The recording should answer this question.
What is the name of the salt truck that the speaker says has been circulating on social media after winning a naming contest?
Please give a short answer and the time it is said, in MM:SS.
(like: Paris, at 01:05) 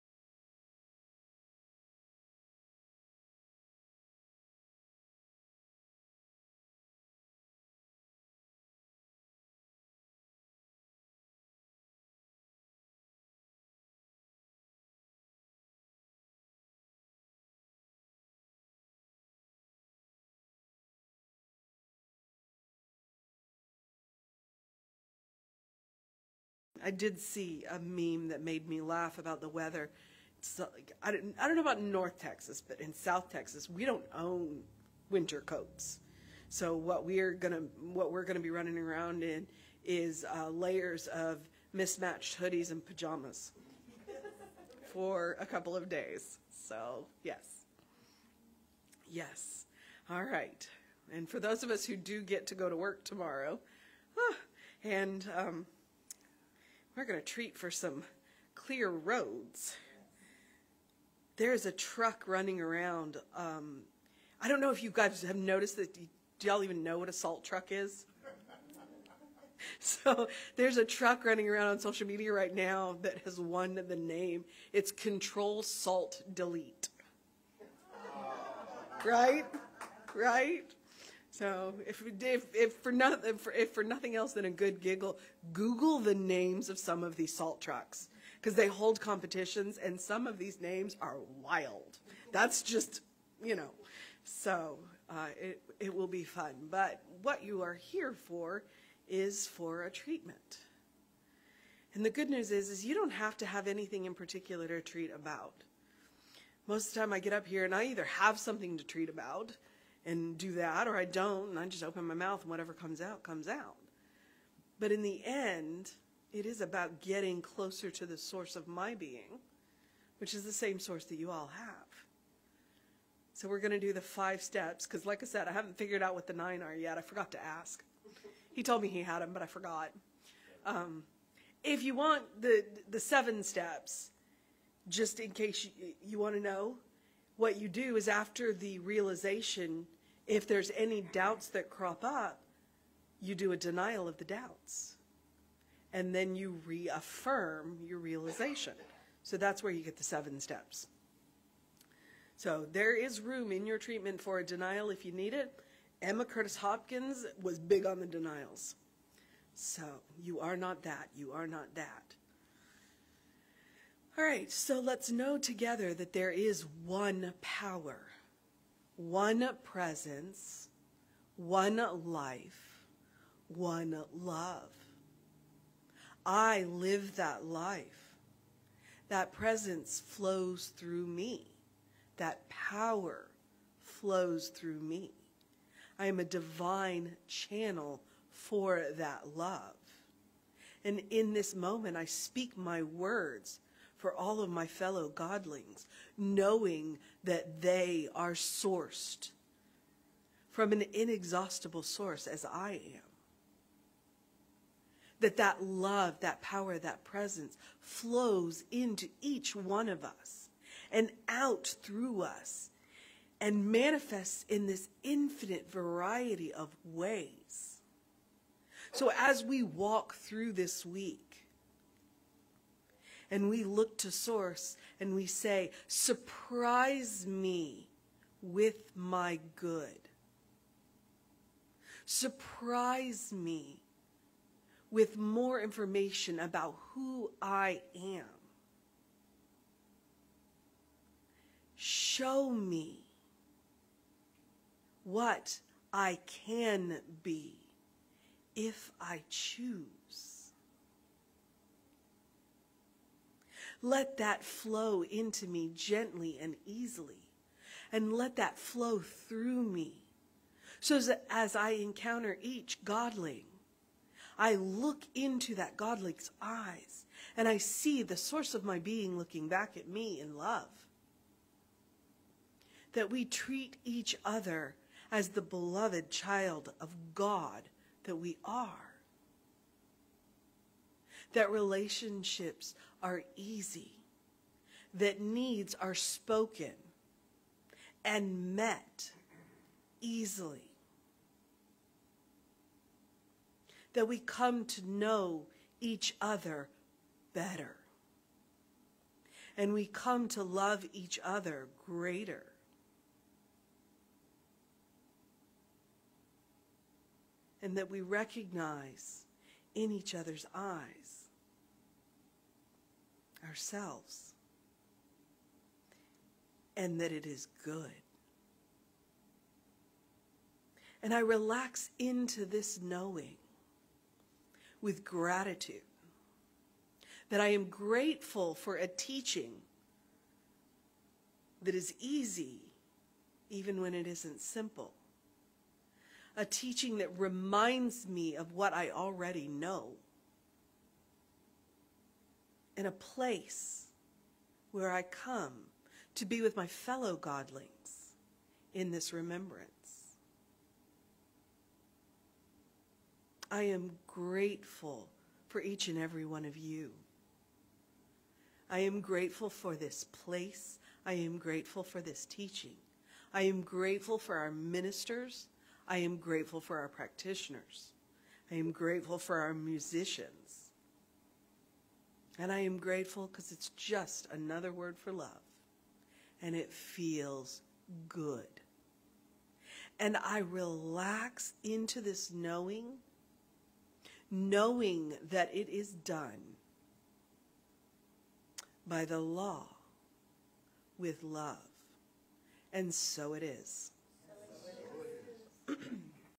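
Control Salt Delete, at 01:14.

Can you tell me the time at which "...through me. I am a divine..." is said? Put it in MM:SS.
03:04.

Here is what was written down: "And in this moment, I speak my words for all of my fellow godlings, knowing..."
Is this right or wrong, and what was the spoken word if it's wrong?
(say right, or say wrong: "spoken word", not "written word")
right.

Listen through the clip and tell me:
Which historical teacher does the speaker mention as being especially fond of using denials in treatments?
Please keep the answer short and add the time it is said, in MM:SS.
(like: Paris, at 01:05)
Emma Curtis Hopkins, at 02:36.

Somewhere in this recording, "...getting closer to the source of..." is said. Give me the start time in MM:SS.
01:57.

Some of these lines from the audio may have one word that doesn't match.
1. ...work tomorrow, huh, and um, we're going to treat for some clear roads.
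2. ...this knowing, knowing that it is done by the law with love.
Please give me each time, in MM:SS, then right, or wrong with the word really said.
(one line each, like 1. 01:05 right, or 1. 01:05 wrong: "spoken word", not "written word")
1. 00:52 right
2. 06:22 right.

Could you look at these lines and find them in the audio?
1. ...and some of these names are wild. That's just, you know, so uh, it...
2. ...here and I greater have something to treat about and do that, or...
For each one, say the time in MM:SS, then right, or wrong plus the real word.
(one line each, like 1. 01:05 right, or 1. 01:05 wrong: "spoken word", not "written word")
1. 01:29 right
2. 01:47 wrong: "either", not "greater".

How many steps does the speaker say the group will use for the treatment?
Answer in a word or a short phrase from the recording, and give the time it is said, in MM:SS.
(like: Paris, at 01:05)
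5, at 02:04.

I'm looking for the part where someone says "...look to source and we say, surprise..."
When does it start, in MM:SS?
03:43.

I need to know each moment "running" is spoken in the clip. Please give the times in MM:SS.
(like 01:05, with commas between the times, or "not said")
00:38, 01:02, 01:11.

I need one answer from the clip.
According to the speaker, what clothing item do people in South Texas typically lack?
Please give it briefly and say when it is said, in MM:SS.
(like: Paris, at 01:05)
Winter coats, at 00:35.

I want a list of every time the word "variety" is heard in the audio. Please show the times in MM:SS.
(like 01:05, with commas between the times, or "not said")
03:35.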